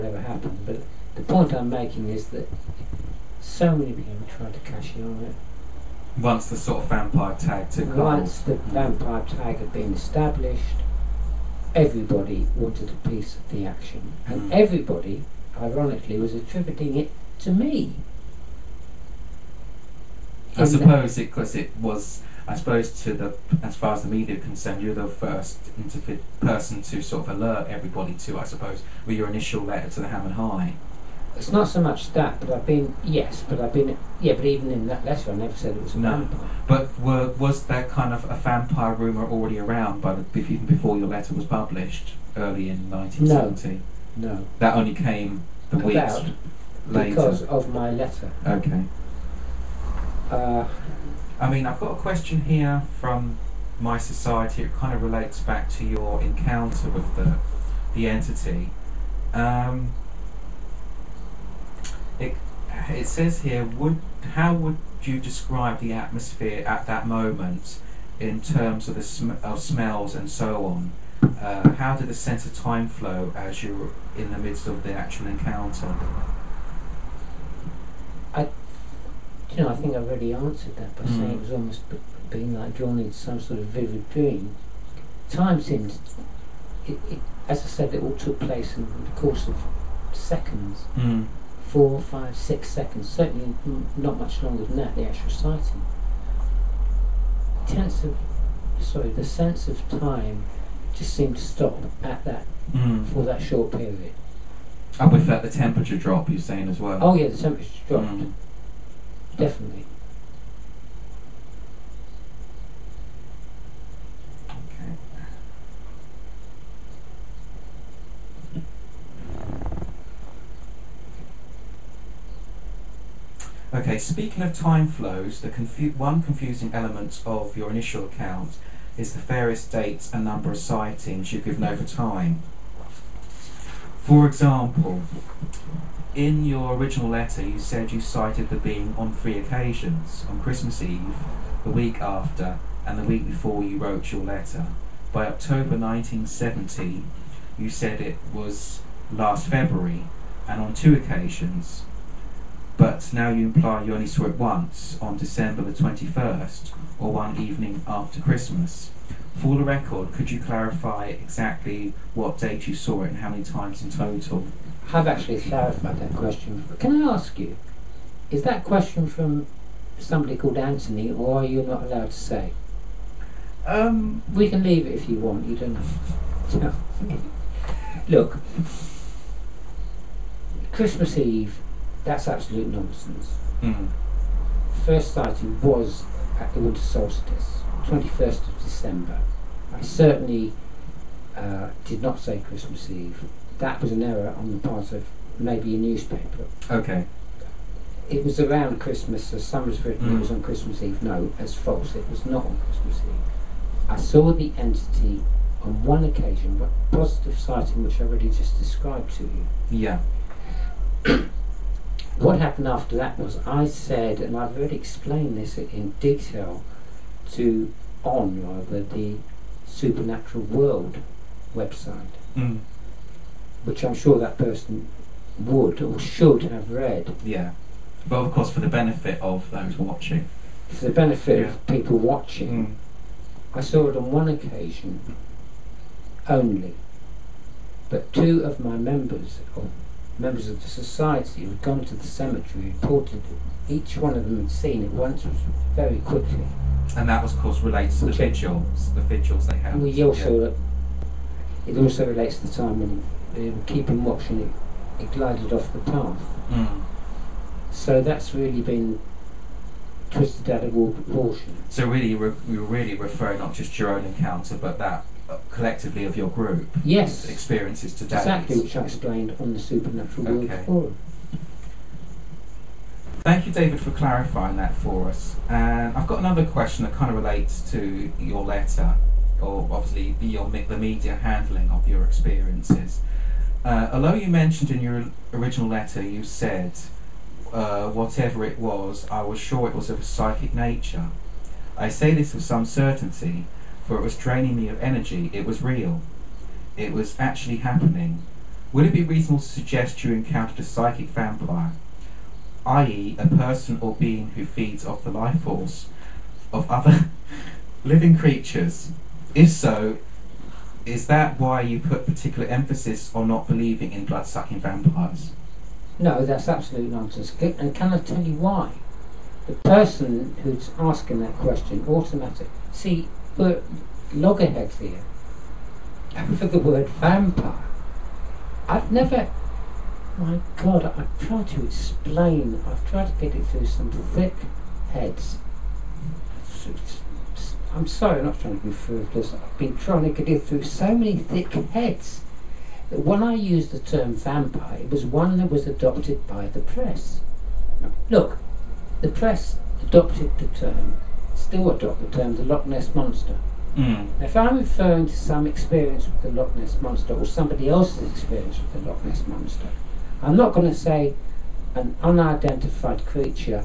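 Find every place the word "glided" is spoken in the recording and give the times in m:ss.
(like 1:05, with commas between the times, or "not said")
4:15.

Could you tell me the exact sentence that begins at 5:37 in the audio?
I'm sorry, I'm not trying to be frivolous.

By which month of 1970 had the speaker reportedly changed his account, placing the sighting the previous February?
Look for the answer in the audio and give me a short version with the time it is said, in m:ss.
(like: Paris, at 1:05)
October, at 2:25.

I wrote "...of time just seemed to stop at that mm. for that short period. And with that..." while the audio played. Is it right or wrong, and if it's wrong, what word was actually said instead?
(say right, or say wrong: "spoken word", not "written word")
right.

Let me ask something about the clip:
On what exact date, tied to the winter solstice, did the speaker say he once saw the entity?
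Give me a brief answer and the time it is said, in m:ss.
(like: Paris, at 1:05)
21st of December, at 3:07.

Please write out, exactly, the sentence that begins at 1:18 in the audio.
I, you know, I think I've already answered that by mm.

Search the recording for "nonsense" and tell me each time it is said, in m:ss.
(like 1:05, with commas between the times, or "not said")
3:02, 5:16.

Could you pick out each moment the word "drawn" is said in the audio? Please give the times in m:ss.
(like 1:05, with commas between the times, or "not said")
1:22.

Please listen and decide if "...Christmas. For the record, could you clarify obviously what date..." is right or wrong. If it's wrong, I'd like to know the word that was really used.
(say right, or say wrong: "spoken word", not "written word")
wrong: "exactly", not "obviously".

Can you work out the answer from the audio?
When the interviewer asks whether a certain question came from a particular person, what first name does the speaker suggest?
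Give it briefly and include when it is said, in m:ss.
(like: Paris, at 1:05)
Anthony, at 2:50.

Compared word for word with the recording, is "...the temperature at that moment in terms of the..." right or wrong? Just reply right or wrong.
wrong.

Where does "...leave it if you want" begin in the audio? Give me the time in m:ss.
2:54.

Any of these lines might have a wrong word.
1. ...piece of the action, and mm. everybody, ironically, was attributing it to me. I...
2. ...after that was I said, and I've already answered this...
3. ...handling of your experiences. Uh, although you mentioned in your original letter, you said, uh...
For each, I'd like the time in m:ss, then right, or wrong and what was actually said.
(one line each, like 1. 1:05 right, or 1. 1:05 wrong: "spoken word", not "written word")
1. 0:13 right
2. 3:32 wrong: "explained", not "answered"
3. 4:41 right.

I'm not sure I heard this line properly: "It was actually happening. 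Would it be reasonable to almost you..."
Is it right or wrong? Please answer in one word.
wrong.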